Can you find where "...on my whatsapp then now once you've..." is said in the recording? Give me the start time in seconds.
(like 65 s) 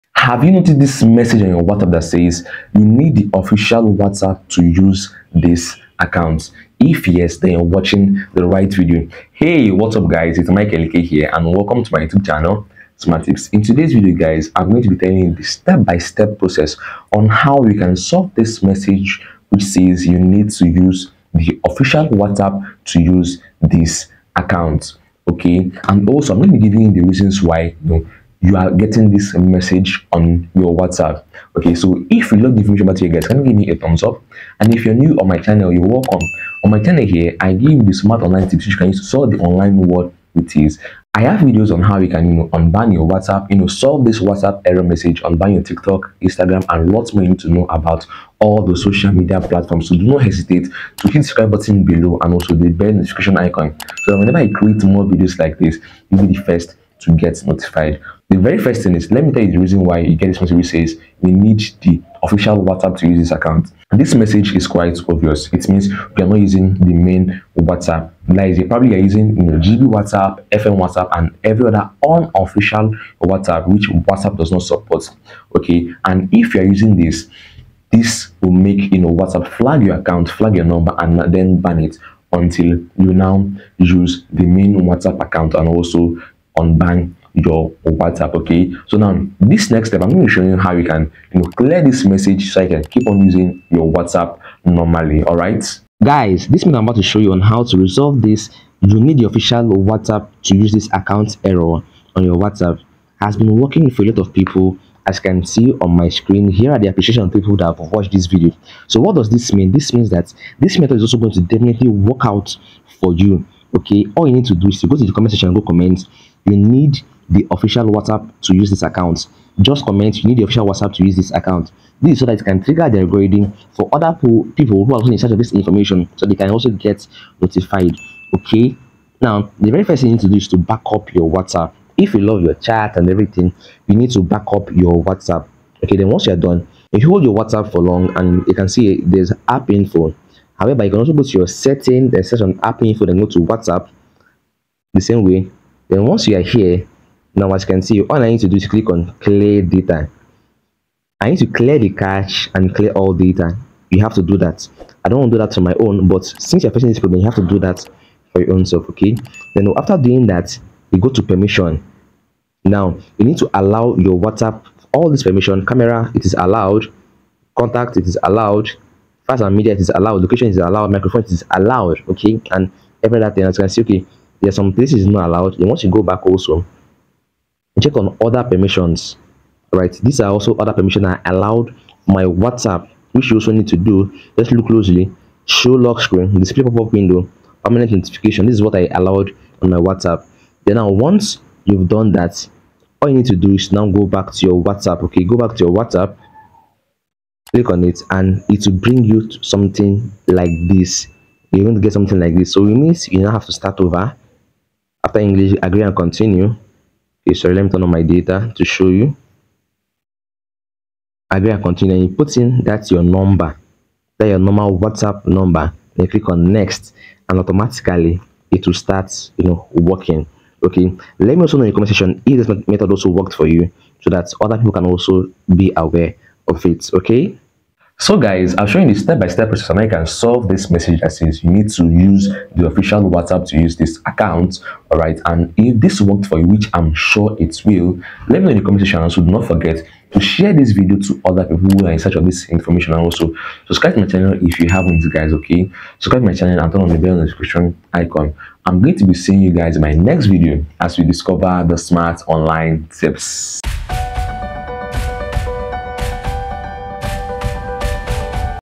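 189 s.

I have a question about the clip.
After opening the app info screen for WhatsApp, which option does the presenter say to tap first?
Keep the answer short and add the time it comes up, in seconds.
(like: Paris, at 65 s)
Clear data, at 149 s.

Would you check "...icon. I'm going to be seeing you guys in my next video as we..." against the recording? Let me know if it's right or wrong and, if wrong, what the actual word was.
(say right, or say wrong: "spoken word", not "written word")
right.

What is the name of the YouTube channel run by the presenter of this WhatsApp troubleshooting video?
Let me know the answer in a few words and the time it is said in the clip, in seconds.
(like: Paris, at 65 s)
Smart Tips, at 12 s.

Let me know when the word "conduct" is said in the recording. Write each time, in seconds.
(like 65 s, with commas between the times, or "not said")
not said.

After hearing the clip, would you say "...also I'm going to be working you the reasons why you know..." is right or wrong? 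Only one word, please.
wrong.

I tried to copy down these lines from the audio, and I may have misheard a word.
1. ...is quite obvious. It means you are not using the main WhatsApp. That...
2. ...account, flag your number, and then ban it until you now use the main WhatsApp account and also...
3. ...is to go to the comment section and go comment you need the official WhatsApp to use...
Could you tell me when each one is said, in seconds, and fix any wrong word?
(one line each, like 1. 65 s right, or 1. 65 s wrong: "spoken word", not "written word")
1. 64 s right
2. 79 s right
3. 114 s right.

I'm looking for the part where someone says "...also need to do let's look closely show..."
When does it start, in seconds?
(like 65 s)
183 s.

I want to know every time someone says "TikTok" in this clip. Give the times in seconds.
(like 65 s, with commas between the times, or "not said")
45 s.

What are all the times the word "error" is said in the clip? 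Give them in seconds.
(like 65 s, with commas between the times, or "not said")
44 s, 101 s.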